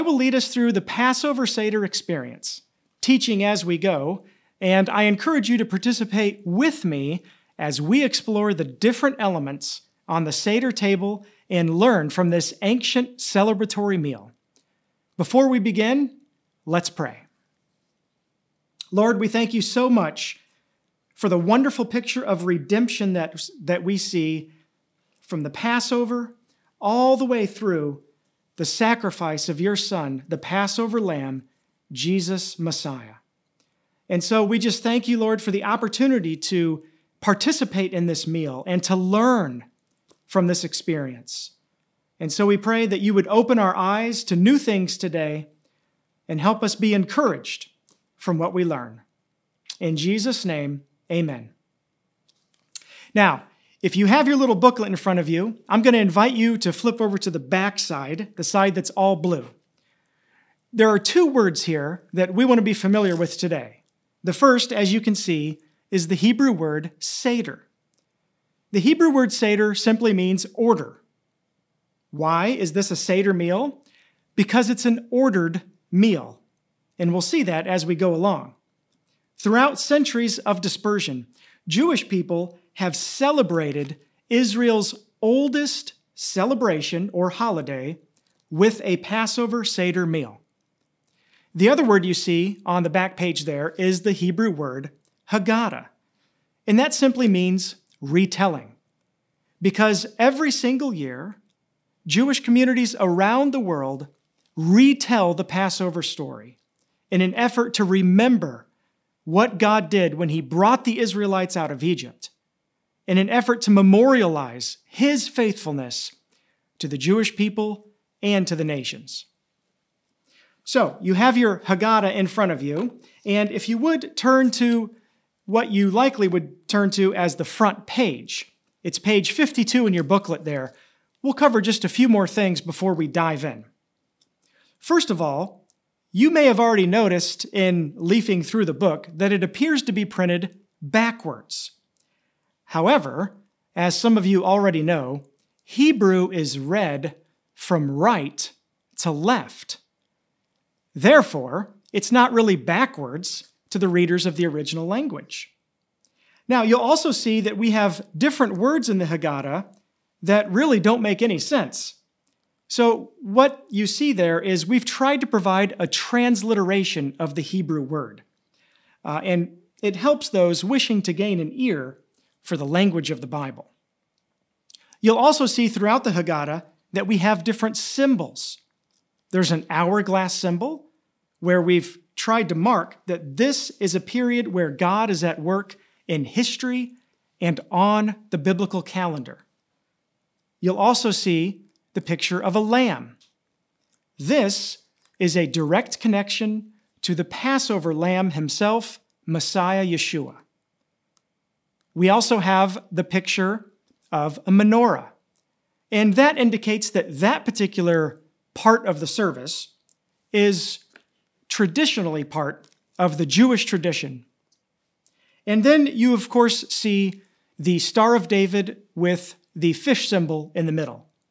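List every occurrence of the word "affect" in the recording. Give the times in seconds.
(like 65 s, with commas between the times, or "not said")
not said.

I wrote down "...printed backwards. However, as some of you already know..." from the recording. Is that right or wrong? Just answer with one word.
right.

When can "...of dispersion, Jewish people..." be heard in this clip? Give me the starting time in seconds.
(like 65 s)
80 s.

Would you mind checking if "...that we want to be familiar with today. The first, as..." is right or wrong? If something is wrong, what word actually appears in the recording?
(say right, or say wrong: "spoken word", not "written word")
right.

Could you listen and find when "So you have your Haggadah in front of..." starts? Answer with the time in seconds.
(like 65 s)
120 s.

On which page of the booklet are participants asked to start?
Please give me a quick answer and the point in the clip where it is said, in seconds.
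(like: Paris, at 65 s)
52, at 128 s.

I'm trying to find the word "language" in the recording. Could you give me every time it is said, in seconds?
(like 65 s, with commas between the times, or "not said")
154 s, 172 s.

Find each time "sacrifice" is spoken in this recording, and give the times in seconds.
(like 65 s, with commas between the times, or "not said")
28 s.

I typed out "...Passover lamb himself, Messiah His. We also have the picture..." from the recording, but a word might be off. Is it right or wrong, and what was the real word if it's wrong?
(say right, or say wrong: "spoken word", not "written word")
wrong: "Yeshua", not "His".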